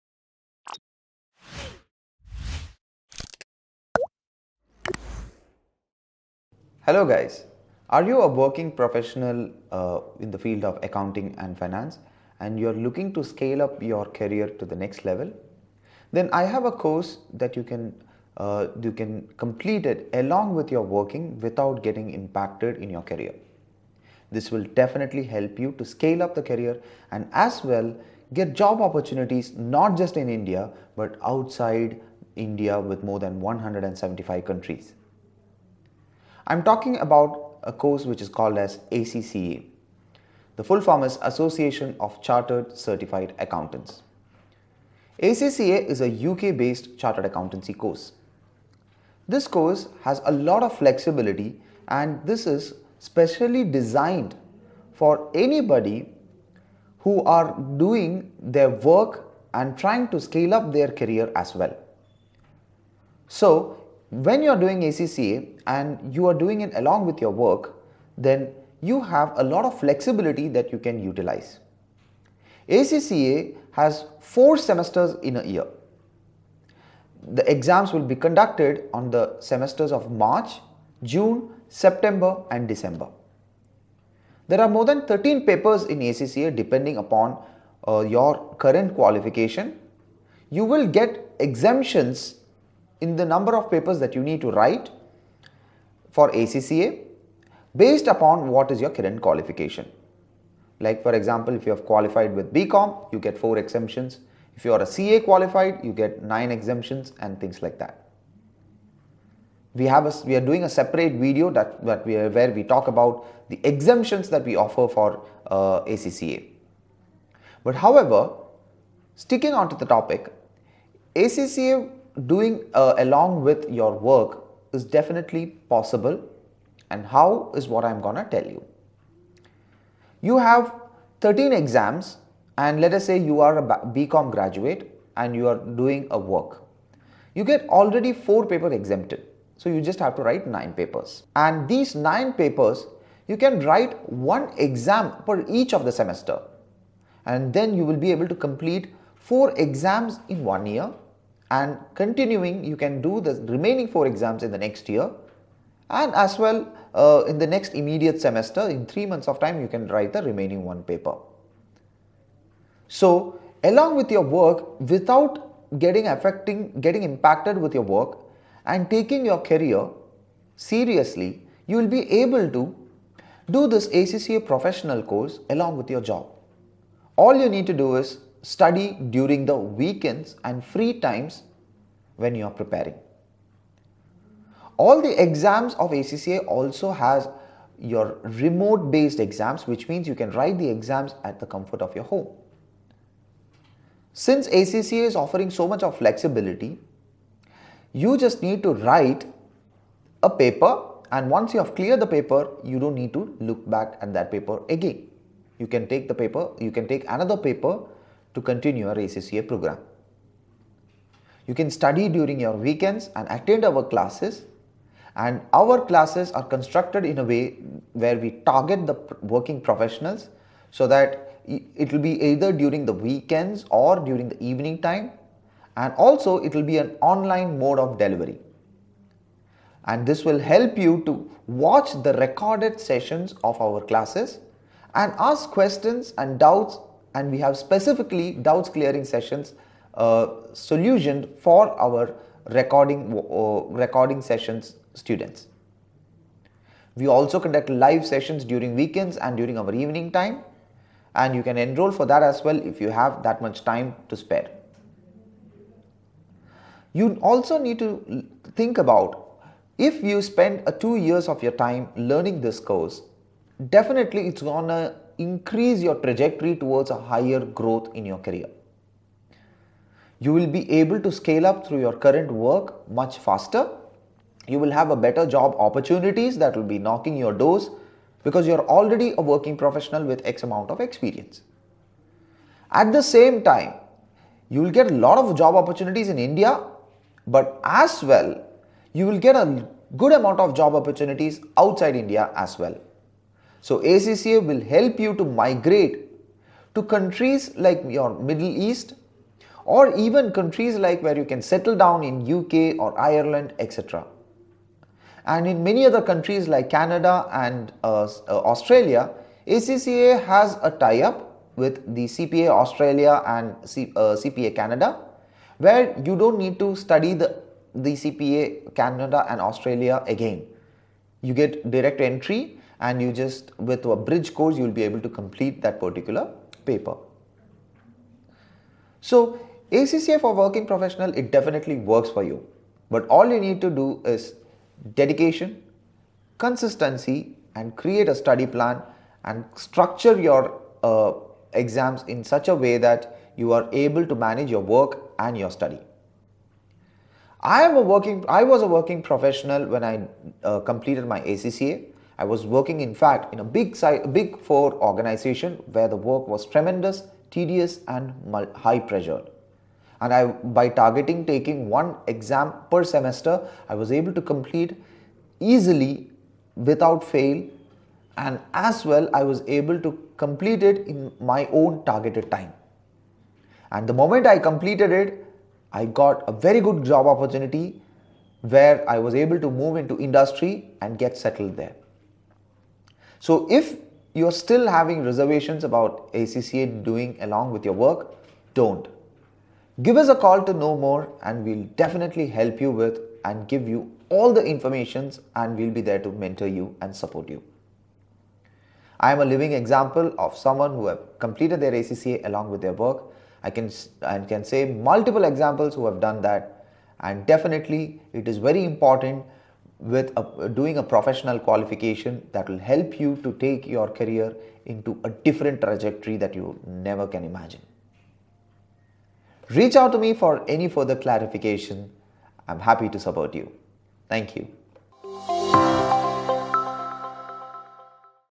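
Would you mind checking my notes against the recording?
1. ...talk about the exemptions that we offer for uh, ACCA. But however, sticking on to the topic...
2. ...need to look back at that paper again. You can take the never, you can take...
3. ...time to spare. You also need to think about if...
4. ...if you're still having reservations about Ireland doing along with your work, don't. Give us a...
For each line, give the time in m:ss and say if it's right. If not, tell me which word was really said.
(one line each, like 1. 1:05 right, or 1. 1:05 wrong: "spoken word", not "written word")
1. 1:52 right
2. 3:22 wrong: "paper", not "never"
3. 4:13 right
4. 6:23 wrong: "ACCA", not "Ireland".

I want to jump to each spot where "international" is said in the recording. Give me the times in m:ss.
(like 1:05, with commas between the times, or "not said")
not said.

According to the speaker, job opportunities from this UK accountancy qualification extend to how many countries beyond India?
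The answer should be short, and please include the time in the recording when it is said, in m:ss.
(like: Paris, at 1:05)
175, at 0:33.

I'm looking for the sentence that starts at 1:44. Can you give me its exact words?
If you are a CA qualified, you get 9 exemptions and things like that.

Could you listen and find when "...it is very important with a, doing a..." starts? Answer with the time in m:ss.
6:48.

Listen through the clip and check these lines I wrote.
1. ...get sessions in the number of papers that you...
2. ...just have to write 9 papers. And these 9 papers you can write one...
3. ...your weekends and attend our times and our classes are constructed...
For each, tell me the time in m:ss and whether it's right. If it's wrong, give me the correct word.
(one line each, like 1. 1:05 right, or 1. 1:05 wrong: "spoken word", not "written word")
1. 1:30 wrong: "exemptions", not "sessions"
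2. 2:19 right
3. 3:32 wrong: "classes", not "times".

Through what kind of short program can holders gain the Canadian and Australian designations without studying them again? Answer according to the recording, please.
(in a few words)
bridge course.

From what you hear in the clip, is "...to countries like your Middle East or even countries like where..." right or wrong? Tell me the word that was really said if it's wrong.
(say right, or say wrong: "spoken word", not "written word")
right.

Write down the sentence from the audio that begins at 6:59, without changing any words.
Reach out to me for any further clarification.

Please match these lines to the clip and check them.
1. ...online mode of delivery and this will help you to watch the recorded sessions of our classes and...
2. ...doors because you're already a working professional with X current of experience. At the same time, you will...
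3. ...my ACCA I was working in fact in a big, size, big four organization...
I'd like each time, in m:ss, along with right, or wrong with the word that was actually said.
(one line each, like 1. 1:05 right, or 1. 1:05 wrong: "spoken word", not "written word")
1. 3:47 right
2. 4:37 wrong: "amount", not "current"
3. 5:51 right.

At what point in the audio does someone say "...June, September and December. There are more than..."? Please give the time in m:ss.
1:21.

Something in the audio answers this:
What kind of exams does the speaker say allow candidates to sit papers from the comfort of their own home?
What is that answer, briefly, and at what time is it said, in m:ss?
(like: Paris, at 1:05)
remote based exams, at 3:08.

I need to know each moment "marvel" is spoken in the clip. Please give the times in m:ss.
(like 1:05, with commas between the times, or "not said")
not said.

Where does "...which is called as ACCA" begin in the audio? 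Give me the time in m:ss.
0:38.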